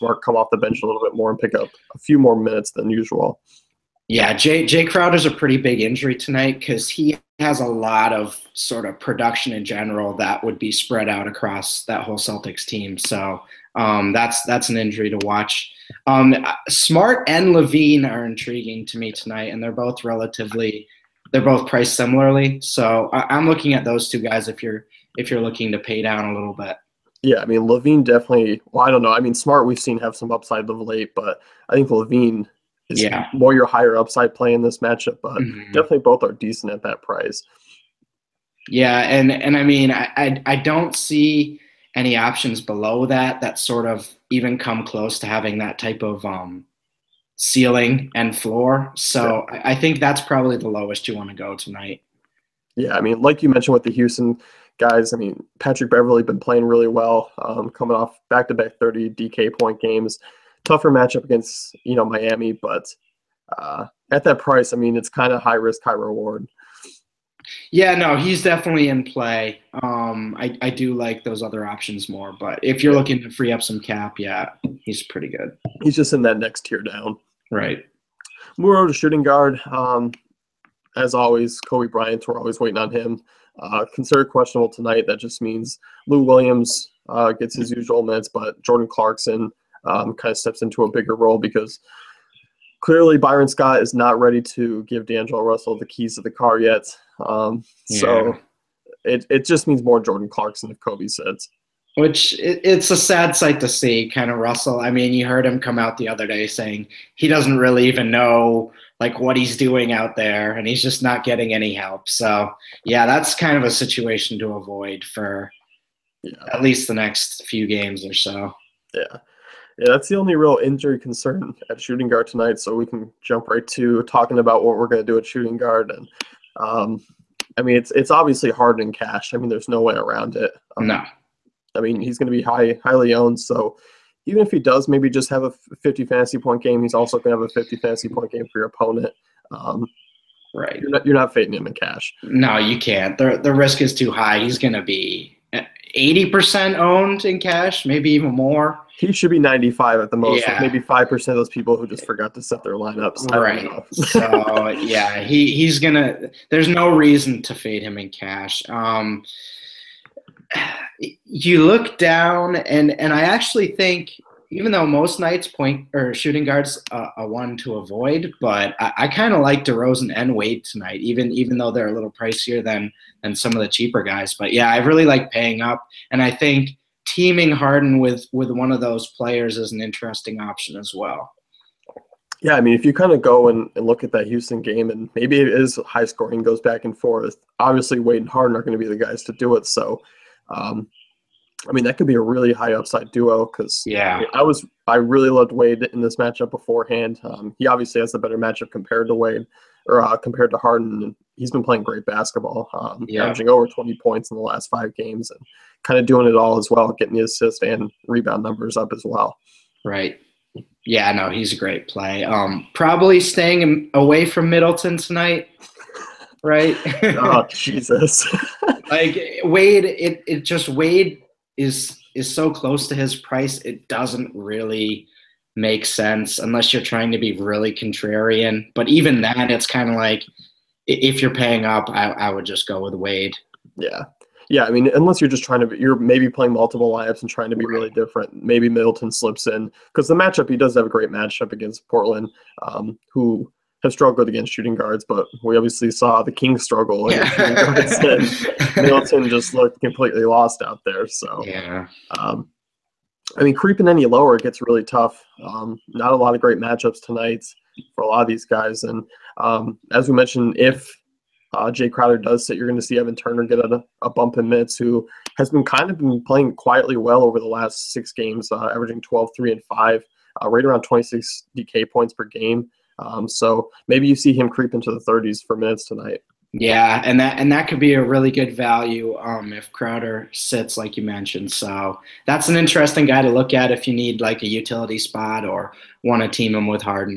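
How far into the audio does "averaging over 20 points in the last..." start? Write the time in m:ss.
3:23.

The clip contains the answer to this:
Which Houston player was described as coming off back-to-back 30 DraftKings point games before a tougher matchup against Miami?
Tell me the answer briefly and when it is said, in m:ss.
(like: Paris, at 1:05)
Patrick Beverley, at 0:55.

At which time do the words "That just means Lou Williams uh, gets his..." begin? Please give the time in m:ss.
1:25.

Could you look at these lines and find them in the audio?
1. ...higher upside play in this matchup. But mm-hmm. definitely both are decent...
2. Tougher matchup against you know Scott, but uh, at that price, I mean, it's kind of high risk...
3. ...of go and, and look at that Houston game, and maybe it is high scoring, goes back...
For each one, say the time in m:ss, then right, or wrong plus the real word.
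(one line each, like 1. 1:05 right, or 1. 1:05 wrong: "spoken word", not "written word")
1. 0:33 right
2. 1:00 wrong: "Miami", not "Scott"
3. 3:03 right.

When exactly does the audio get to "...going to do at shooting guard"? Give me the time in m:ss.
2:04.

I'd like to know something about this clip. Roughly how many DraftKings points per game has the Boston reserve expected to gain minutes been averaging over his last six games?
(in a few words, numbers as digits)
26.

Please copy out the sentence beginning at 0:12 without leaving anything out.
So um, that's that's an injury to watch.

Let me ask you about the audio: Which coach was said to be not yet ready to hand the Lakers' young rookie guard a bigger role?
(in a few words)
Byron Scott.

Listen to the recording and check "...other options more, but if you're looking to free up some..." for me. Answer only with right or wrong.
right.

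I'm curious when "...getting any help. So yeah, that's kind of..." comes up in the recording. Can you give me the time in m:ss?
1:51.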